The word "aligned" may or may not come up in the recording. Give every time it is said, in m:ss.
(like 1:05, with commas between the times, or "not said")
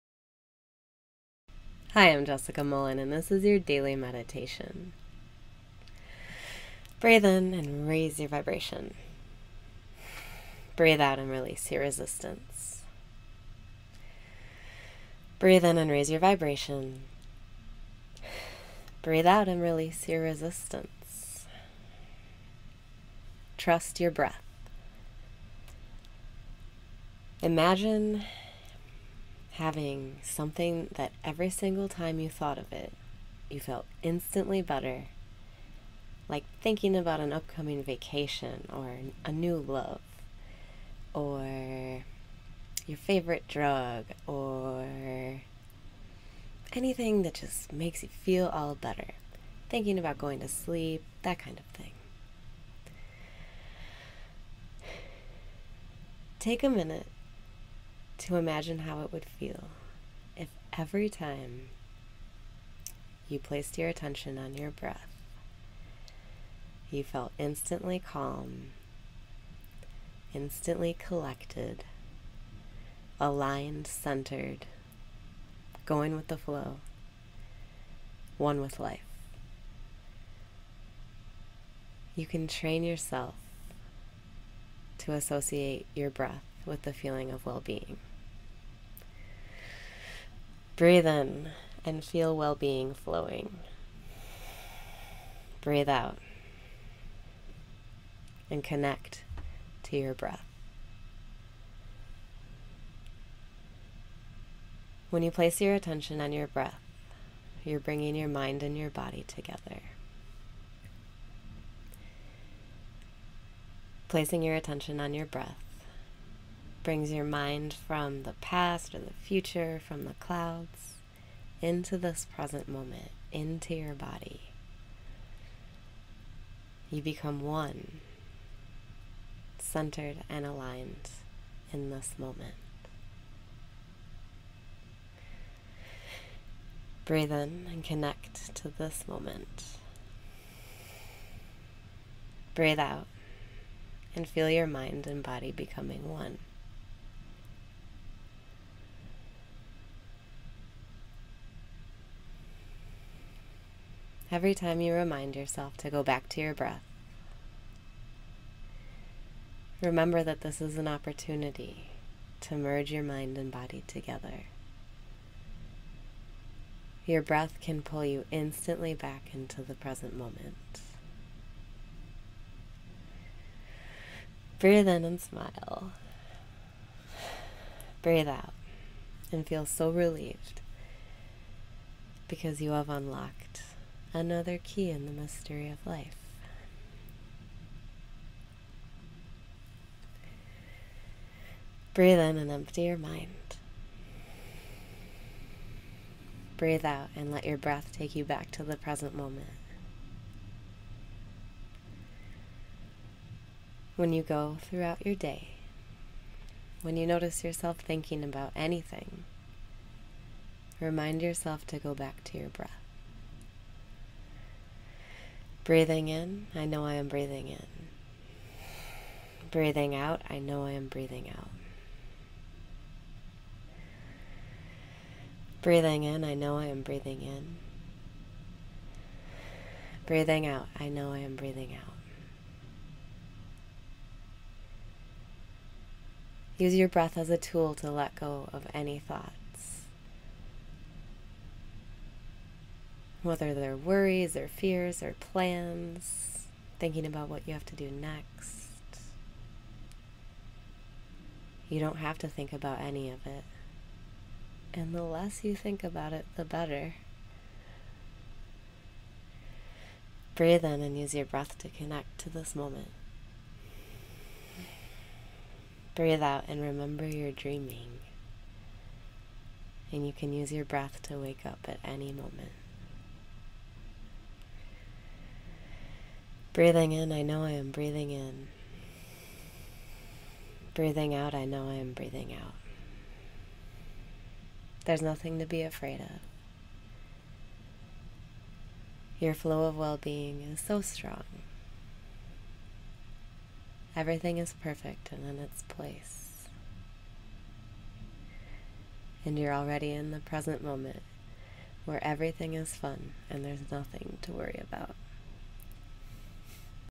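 1:13, 2:10.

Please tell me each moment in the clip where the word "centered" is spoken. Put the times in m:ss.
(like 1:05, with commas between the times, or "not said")
1:13, 2:09.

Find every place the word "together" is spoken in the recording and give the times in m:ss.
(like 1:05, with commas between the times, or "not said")
1:49, 2:43.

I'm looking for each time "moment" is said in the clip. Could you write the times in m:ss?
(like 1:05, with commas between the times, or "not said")
2:02, 2:12, 2:19, 2:50, 3:19, 4:22, 4:32, 5:00.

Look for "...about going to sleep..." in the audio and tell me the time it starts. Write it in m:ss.
0:49.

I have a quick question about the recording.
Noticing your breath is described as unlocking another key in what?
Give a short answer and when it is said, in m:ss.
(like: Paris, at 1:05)
the mystery of life, at 3:05.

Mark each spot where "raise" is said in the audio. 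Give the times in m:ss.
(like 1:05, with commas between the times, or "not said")
0:07, 0:15.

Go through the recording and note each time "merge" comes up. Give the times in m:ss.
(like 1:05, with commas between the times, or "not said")
2:42.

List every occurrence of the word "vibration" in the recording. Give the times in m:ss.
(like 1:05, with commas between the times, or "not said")
0:08, 0:16.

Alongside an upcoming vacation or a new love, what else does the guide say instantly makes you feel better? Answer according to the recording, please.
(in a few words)
your favorite drug.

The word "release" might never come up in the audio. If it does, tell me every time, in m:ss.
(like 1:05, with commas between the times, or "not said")
0:11, 0:19.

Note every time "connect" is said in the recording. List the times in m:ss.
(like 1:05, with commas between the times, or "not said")
1:38, 2:17, 4:21.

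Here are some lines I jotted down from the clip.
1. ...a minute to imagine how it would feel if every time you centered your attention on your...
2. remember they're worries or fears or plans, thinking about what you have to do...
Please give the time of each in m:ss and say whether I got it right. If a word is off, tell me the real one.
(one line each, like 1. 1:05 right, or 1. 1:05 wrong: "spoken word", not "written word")
1. 0:56 wrong: "placed", not "centered"
2. 4:03 wrong: "whether", not "remember".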